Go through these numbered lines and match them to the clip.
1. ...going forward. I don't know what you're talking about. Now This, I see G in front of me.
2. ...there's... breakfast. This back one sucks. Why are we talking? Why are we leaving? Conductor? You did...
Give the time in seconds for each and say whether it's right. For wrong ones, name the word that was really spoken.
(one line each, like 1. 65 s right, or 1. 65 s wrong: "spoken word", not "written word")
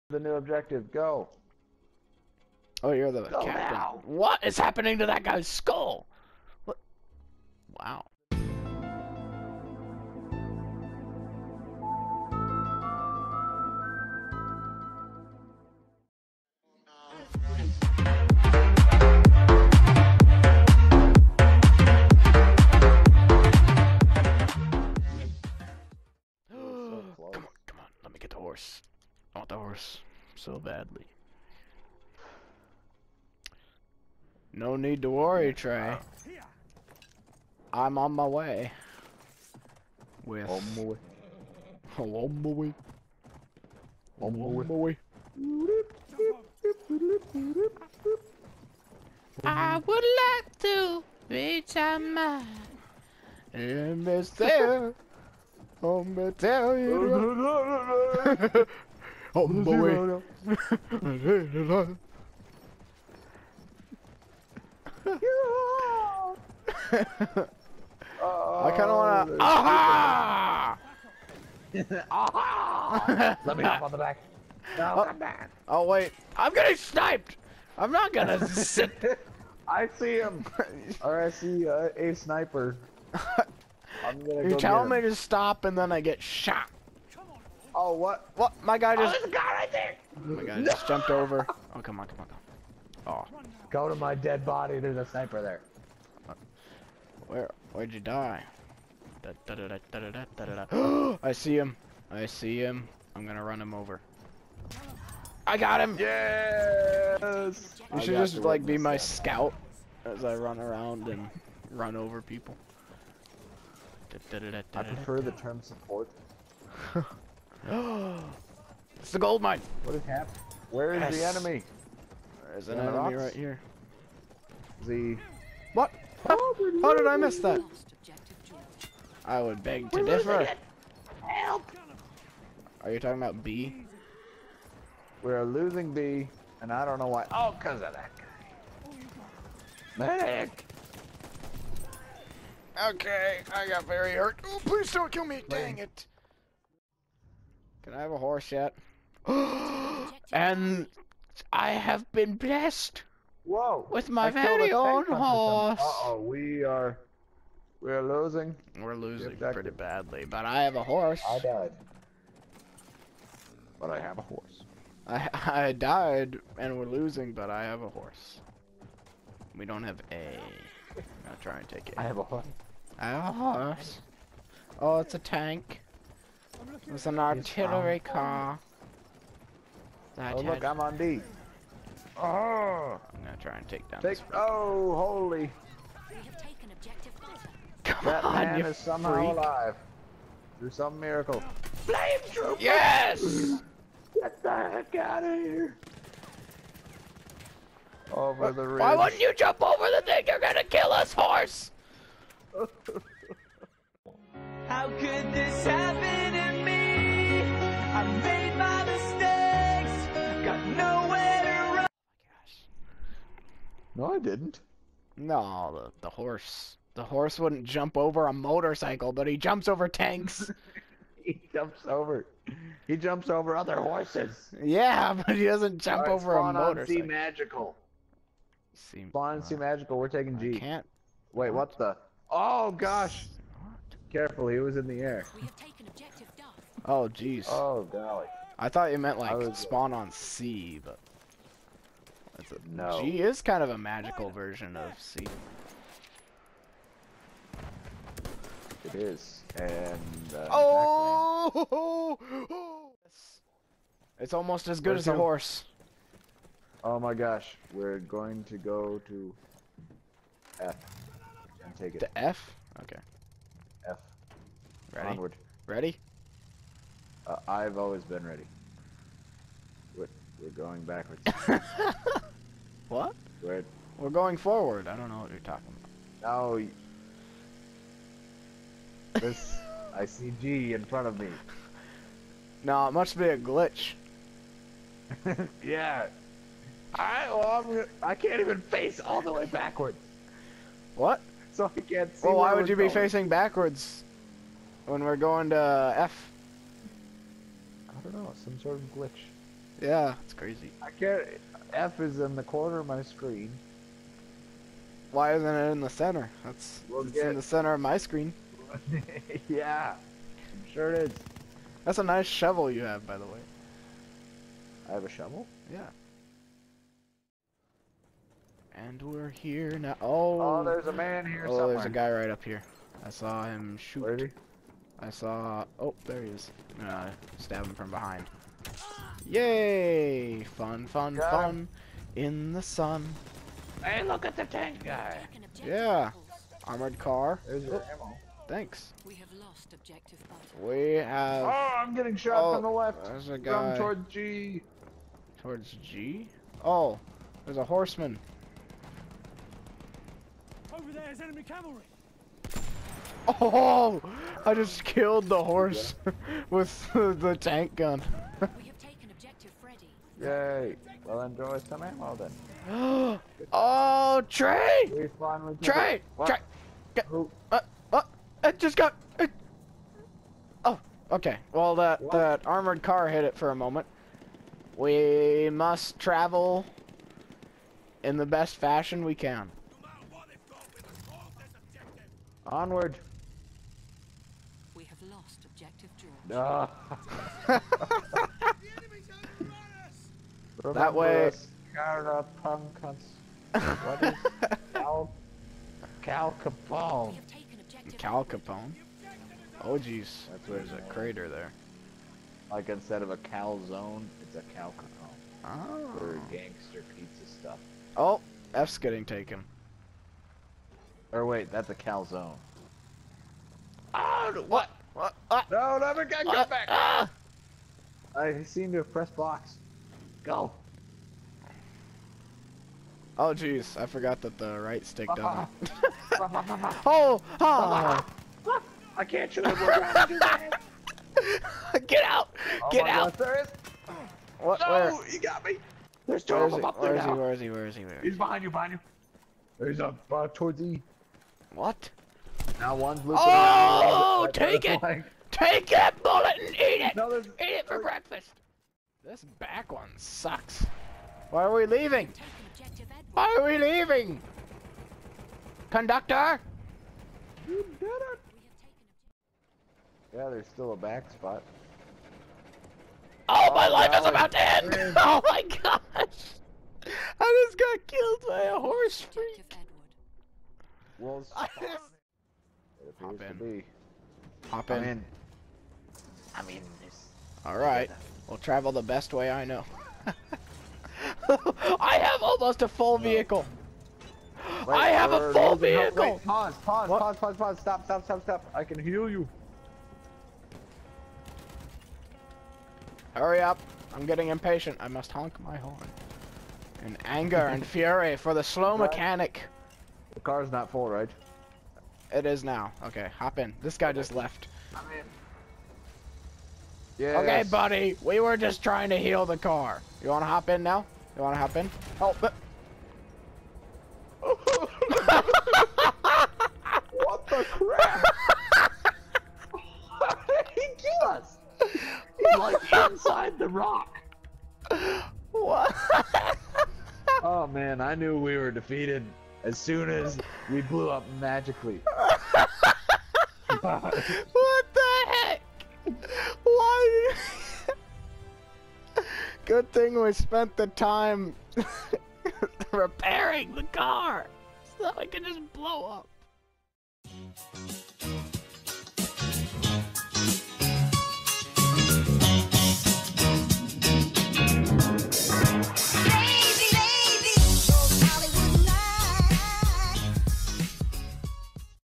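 1. 274 s right
2. 447 s wrong: "leaving", not "talking".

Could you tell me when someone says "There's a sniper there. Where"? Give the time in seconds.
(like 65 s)
94 s.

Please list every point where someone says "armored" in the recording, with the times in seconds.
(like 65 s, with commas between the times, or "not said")
336 s, 372 s.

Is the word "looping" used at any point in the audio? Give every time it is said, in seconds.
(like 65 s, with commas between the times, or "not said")
443 s.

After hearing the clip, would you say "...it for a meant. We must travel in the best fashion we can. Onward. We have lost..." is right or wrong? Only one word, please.
wrong.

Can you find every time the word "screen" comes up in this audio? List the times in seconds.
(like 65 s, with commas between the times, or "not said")
303 s, 307 s.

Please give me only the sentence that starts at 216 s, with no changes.
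The horse wouldn't jump over a motorcycle, but he jumps over tanks.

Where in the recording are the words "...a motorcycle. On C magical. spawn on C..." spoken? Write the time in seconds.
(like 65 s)
226 s.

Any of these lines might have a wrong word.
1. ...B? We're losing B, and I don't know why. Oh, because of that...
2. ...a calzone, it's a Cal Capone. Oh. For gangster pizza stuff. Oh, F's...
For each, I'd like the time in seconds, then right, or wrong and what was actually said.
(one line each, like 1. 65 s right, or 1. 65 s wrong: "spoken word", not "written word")
1. 133 s right
2. 403 s right.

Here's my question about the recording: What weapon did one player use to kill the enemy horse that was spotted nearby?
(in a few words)
tank gun.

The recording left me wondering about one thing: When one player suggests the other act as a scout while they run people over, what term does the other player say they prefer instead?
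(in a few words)
support.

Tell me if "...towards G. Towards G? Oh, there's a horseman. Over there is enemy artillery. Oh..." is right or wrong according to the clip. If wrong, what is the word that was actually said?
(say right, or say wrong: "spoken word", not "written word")
wrong: "cavalry", not "artillery".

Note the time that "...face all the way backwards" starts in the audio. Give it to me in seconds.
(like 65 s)
288 s.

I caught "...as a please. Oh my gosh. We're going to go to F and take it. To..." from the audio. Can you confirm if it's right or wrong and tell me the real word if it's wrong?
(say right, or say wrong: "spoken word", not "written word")
wrong: "horse", not "please".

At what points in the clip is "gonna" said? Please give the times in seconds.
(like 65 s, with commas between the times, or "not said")
56 s, 78 s, 84 s, 103 s, 183 s, 200 s.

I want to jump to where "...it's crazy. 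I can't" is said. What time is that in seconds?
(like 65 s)
300 s.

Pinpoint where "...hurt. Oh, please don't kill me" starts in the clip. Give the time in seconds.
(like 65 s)
144 s.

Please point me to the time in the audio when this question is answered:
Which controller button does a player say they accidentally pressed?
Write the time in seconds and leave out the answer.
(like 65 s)
418 s.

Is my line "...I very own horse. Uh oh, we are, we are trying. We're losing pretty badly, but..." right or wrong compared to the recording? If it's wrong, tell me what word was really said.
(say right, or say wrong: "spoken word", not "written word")
wrong: "losing", not "trying".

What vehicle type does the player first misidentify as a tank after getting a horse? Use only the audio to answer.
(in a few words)
artillery car.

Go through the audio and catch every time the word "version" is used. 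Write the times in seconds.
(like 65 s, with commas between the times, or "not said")
244 s.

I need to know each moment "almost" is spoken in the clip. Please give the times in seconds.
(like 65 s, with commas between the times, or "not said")
254 s, 482 s.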